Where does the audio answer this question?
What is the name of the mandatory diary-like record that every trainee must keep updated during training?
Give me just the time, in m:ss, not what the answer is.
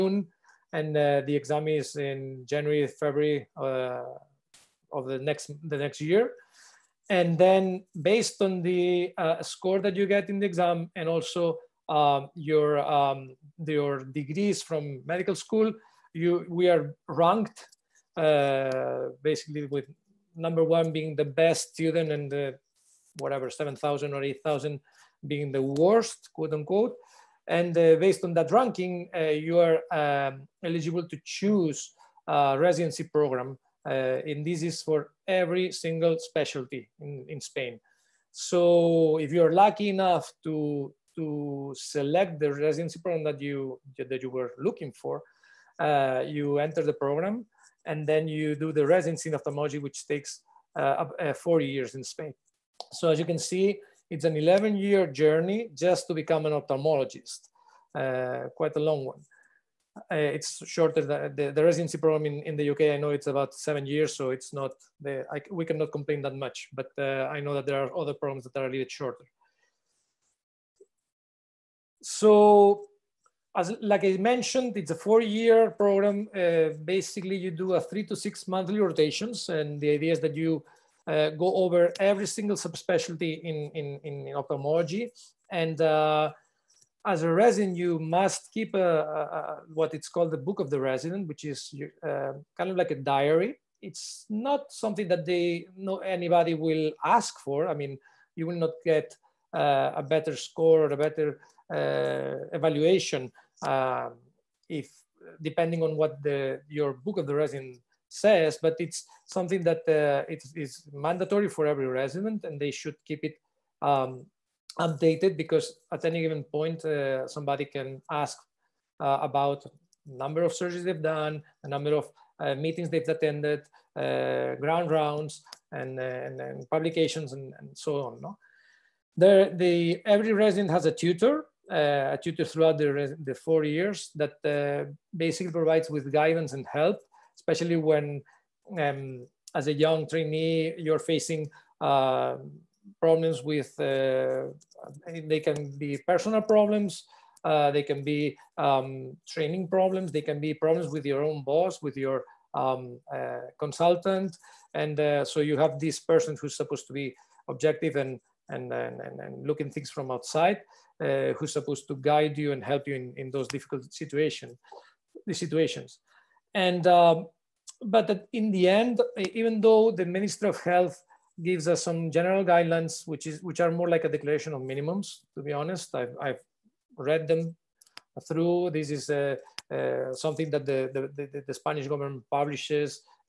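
1:30.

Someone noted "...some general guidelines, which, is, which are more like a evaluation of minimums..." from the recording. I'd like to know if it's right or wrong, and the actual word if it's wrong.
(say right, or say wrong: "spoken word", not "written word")
wrong: "declaration", not "evaluation".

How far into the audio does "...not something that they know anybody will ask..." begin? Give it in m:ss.
1:34.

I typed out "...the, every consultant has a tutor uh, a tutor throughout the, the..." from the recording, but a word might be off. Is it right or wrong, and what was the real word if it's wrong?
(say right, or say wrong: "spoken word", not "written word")
wrong: "resident", not "consultant".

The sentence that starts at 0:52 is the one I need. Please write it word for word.
So as you can see, it's an 11 year journey just to become an ophthalmologist, uh, quite a long one.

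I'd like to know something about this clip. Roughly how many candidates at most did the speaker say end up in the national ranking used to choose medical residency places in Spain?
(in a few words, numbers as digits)
8,000.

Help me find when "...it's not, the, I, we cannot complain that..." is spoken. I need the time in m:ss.
1:04.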